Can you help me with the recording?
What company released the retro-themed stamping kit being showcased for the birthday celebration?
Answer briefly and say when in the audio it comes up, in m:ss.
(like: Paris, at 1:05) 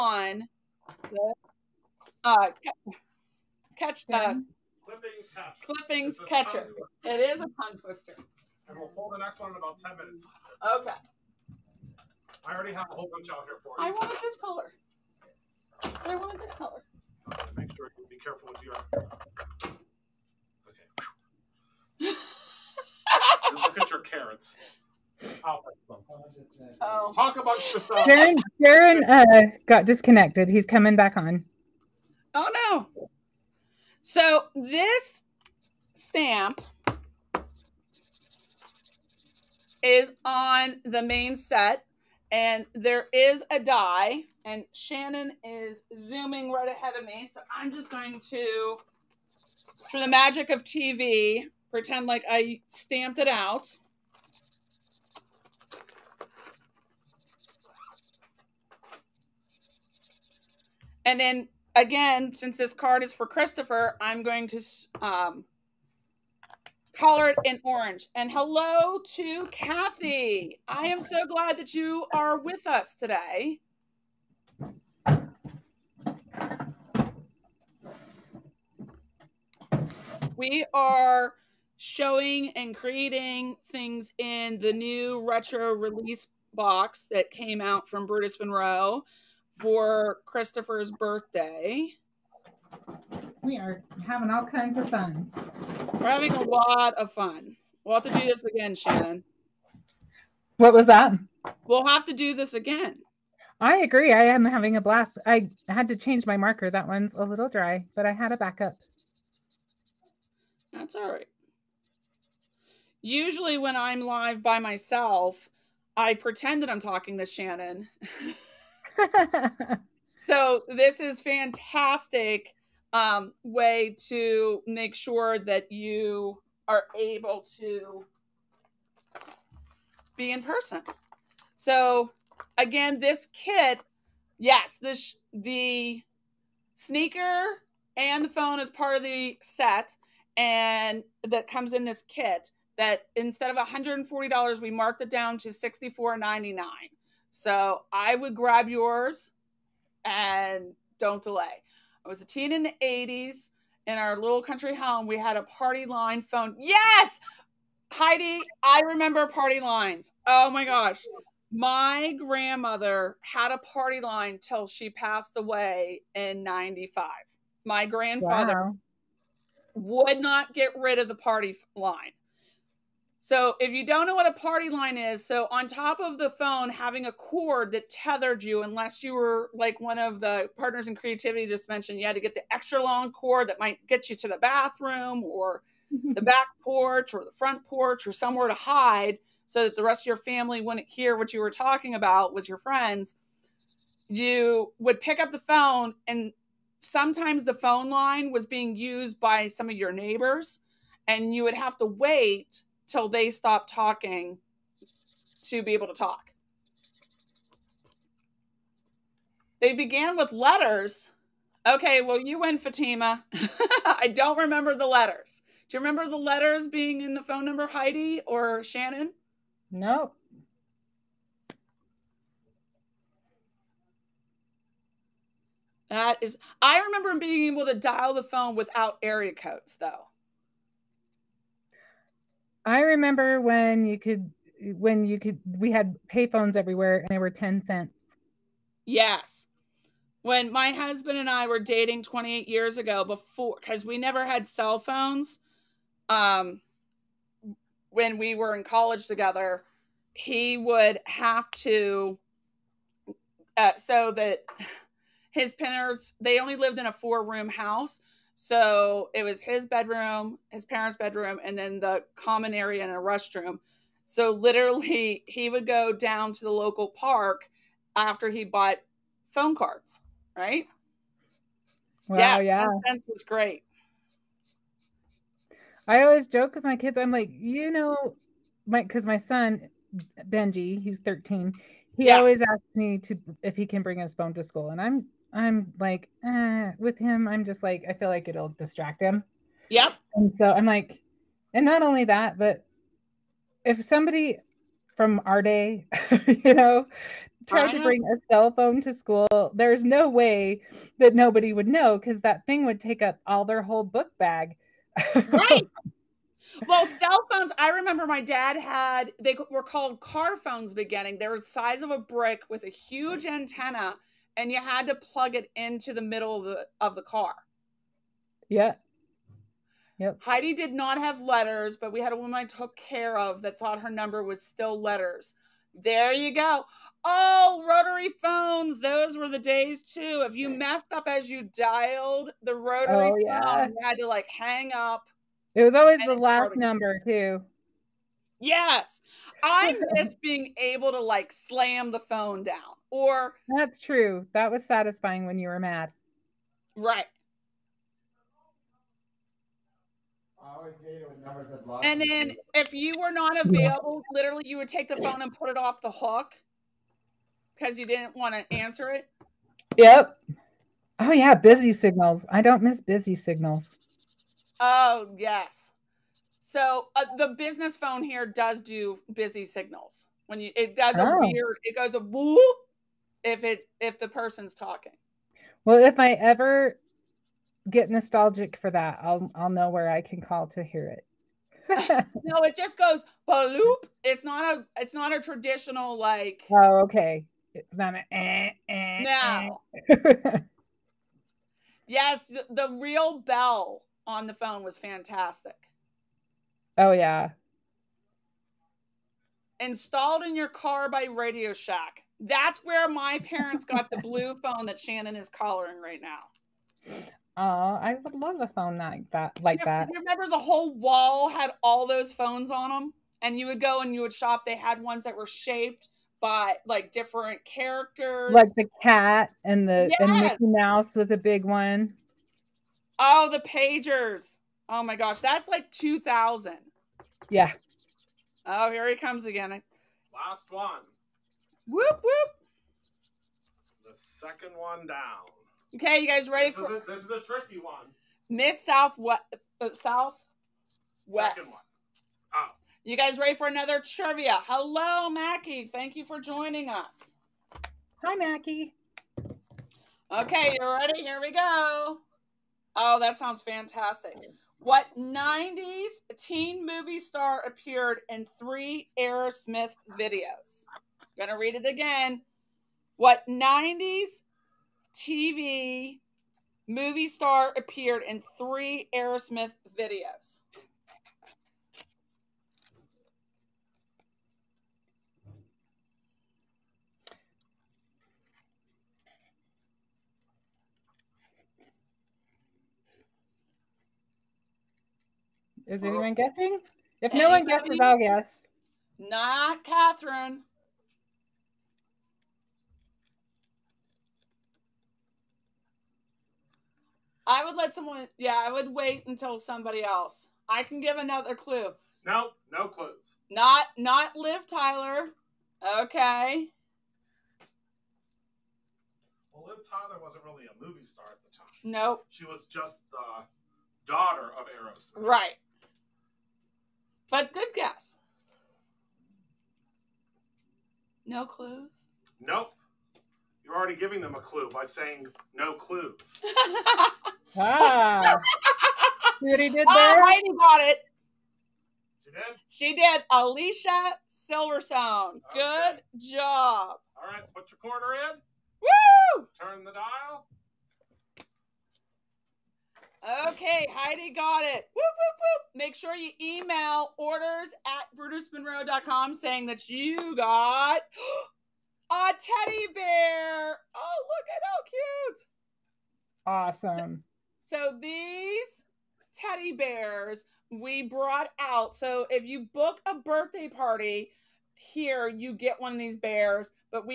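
Brutus Monroe, at 1:28.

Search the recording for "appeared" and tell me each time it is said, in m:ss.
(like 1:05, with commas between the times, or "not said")
7:37, 7:47.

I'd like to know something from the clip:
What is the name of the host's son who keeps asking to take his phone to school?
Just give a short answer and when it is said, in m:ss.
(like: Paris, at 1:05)
Benji, at 4:40.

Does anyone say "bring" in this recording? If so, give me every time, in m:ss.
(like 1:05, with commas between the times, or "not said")
4:43, 4:57.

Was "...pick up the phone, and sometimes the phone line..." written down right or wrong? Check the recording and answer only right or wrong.
right.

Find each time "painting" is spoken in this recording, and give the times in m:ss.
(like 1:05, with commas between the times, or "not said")
not said.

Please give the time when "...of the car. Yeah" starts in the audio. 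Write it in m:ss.
5:16.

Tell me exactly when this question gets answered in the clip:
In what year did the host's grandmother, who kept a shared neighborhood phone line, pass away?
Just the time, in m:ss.
2:46.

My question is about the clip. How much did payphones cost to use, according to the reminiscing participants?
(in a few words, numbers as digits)
10 cents.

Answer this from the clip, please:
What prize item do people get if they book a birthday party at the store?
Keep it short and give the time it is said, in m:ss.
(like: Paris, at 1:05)
teddy bear, at 9:12.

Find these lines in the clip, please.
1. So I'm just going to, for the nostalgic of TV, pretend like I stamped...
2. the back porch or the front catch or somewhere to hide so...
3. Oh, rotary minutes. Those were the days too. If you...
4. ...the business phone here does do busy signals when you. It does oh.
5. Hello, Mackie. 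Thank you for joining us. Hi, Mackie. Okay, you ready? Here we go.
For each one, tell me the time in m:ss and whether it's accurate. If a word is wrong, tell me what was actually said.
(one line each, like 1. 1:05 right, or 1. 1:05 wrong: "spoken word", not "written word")
1. 0:47 wrong: "magic", not "nostalgic"
2. 3:06 wrong: "porch", not "catch"
3. 5:27 wrong: "phones", not "minutes"
4. 6:07 right
5. 7:24 right.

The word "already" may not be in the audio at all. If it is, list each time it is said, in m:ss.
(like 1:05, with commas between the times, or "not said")
0:12, 8:43.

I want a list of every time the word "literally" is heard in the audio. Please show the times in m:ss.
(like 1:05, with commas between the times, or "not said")
4:24, 5:54.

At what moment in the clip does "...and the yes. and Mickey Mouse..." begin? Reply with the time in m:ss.
6:59.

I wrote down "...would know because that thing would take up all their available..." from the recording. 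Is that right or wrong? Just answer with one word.
wrong.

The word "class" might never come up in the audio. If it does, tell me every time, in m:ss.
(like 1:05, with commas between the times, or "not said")
not said.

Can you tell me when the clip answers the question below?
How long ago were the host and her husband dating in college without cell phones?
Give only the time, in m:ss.
4:02.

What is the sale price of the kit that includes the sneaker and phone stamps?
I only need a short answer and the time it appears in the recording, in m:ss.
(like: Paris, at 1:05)
$64.99, at 2:25.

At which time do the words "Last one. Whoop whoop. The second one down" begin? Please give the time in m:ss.
7:10.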